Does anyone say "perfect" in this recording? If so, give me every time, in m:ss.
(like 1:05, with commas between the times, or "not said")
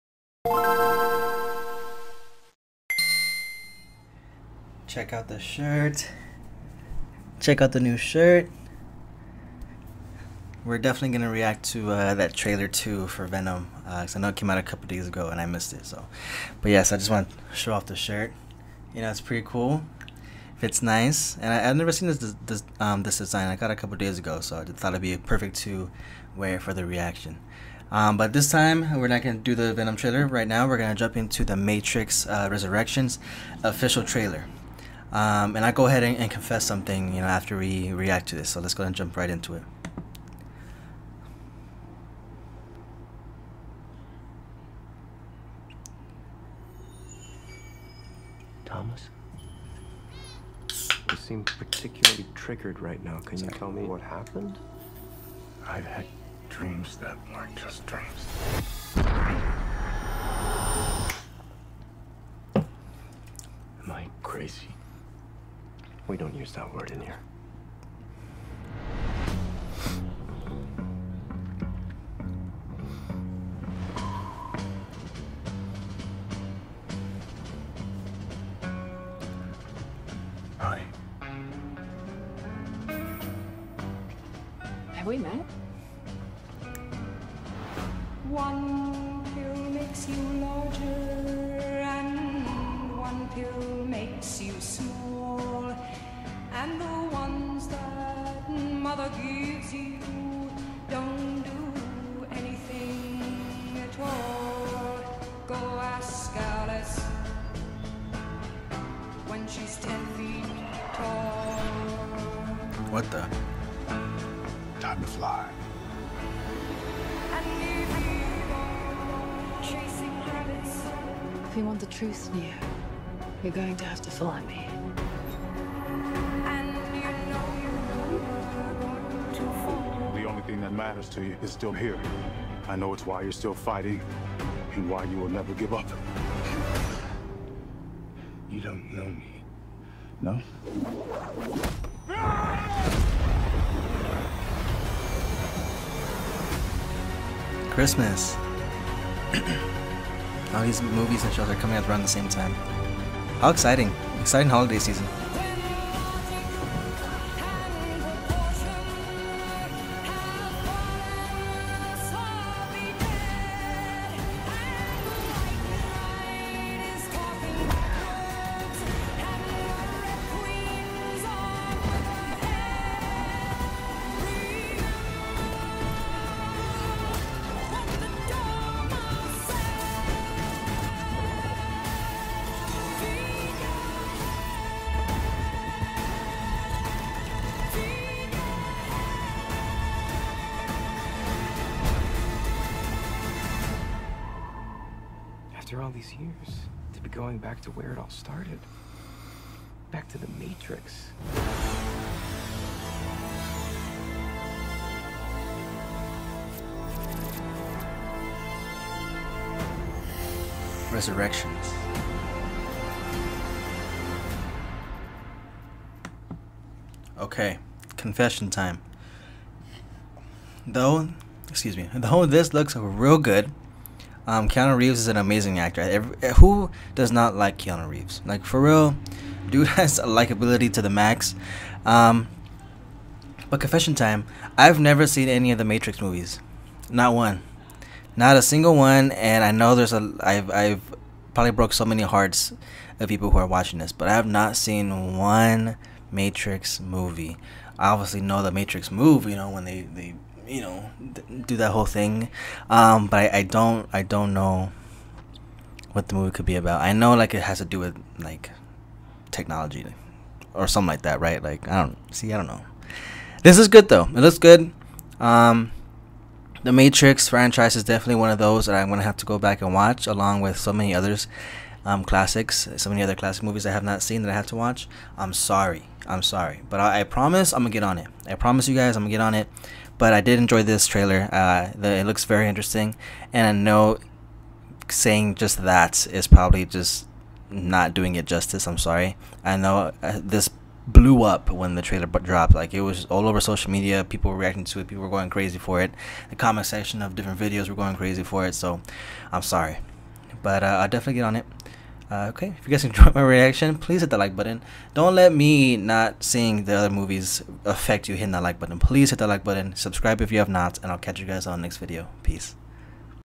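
0:25.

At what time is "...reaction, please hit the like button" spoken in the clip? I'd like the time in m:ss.
5:03.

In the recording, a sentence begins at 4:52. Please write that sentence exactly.
Like it was all over social media.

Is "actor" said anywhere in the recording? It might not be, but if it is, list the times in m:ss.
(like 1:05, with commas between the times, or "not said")
3:45.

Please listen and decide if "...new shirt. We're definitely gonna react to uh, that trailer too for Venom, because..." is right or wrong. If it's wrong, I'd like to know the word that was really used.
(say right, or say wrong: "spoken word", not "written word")
right.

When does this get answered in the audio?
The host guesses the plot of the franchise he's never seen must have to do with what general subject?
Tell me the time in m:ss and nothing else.
4:19.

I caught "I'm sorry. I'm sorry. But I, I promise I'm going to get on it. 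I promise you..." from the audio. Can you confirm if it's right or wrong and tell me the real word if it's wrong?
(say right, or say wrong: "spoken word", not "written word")
right.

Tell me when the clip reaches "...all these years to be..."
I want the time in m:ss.
3:15.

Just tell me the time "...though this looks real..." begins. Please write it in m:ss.
3:41.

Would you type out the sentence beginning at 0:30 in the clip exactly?
Right now, we're going to jump into the Matrix uh, Resurrections official trailer.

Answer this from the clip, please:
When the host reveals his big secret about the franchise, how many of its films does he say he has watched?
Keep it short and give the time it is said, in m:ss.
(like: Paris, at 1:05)
0, at 3:56.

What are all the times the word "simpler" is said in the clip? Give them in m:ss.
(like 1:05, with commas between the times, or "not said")
not said.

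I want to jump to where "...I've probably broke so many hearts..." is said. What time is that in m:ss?
4:00.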